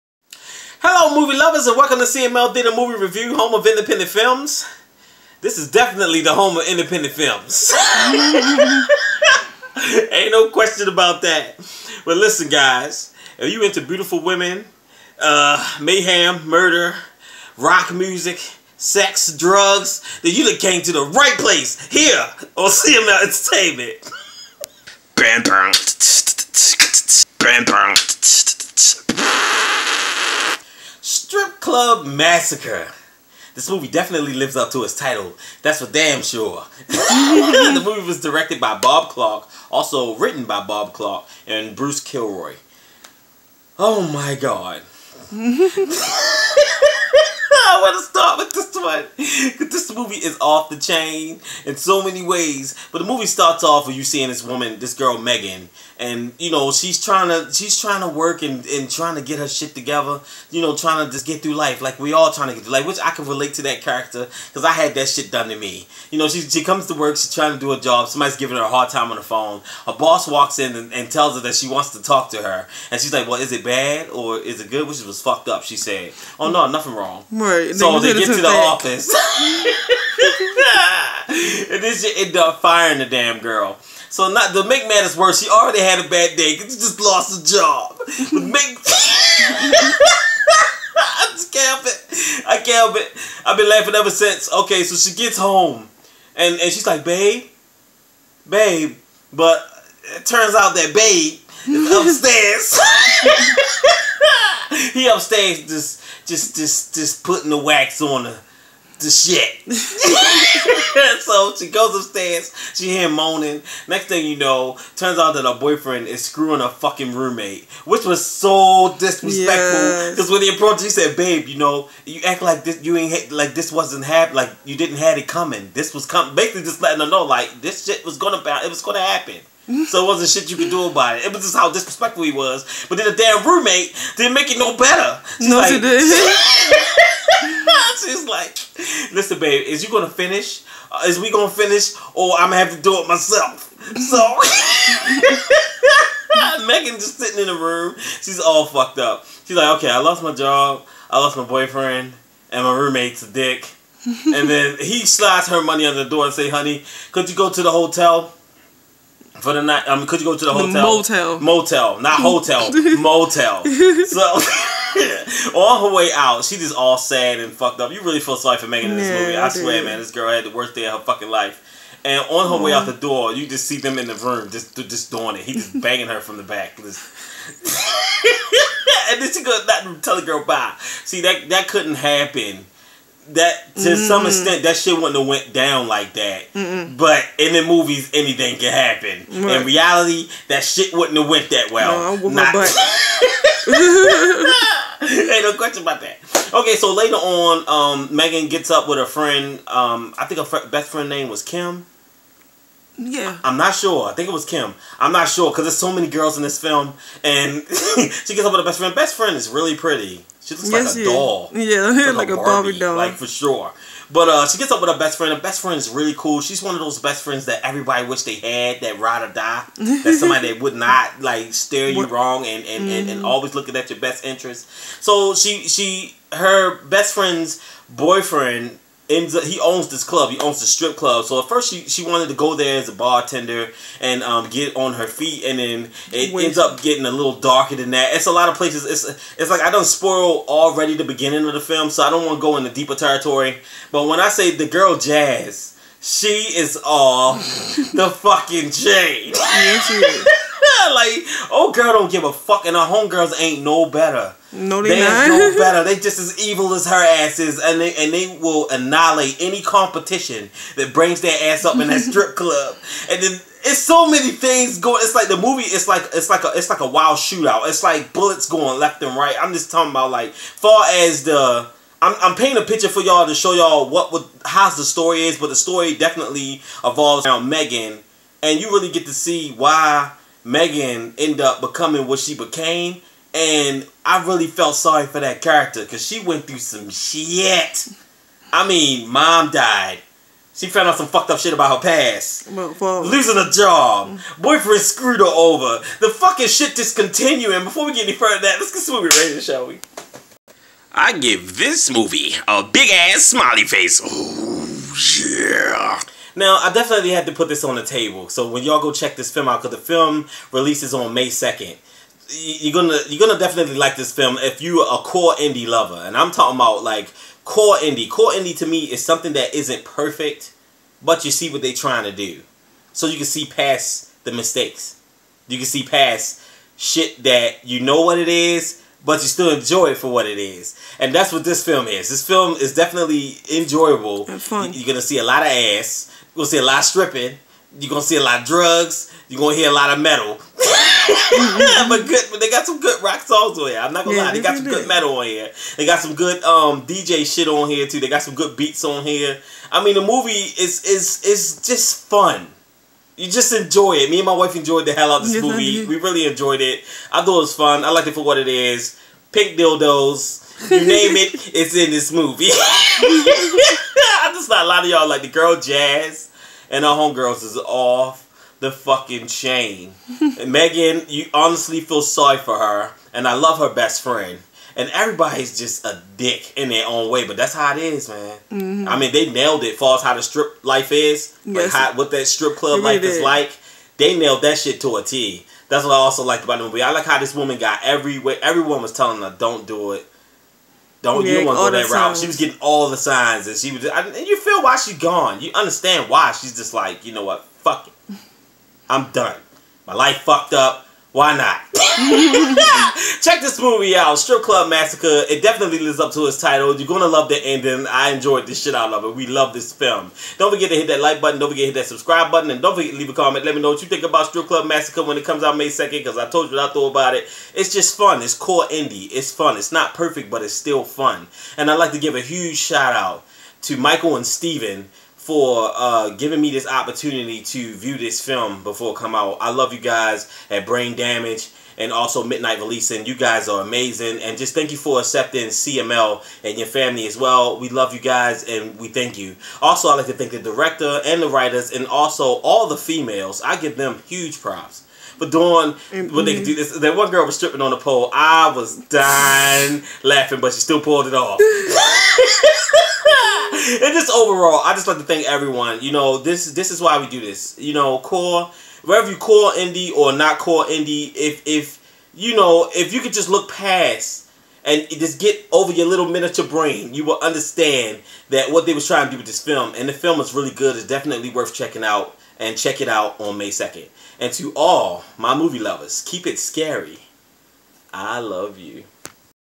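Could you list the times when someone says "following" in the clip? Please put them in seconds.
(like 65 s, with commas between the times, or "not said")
not said.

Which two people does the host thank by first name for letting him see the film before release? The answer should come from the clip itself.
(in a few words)
Michael and Steven.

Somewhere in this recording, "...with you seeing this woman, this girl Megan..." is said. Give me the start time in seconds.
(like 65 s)
53 s.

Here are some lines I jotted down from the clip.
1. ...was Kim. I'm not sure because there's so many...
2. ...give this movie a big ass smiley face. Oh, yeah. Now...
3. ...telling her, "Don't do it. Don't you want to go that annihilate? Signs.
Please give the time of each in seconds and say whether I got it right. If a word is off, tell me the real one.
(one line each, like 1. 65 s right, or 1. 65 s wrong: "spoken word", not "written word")
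1. 204 s right
2. 301 s right
3. 388 s wrong: "route", not "annihilate".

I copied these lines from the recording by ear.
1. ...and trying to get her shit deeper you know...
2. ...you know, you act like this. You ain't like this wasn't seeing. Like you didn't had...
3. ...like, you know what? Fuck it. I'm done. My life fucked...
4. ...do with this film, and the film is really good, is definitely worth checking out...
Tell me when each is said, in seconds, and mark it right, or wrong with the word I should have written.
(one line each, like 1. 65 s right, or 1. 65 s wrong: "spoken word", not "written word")
1. 58 s wrong: "together", not "deeper"
2. 121 s wrong: "happening", not "seeing"
3. 396 s right
4. 469 s right.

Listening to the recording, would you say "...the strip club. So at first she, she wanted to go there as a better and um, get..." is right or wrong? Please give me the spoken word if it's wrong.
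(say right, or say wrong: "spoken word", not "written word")
wrong: "bartender", not "better".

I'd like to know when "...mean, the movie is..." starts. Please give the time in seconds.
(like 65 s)
349 s.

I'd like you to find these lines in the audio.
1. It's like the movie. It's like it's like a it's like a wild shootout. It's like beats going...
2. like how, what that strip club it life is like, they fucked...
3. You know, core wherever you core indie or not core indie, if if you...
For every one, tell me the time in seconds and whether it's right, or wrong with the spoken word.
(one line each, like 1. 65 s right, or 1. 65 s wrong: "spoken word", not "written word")
1. 265 s wrong: "bullets", not "beats"
2. 381 s wrong: "nailed", not "fucked"
3. 457 s right.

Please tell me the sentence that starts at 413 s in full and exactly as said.
Let me know what you think about Strip Club Massacre when it comes out May second.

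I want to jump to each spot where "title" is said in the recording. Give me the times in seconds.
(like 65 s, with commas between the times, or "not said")
34 s, 406 s.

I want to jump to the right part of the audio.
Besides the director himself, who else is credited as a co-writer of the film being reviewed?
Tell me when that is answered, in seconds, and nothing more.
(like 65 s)
41 s.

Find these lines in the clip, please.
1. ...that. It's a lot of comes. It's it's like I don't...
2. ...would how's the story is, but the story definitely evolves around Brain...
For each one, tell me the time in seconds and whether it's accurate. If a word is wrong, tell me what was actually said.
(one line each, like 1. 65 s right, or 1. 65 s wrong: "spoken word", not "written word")
1. 237 s wrong: "places", not "comes"
2. 274 s wrong: "Megan", not "Brain".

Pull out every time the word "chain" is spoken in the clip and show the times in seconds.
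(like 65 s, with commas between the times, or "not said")
50 s, 369 s.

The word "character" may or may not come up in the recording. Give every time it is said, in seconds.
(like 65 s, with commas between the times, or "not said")
63 s, 285 s.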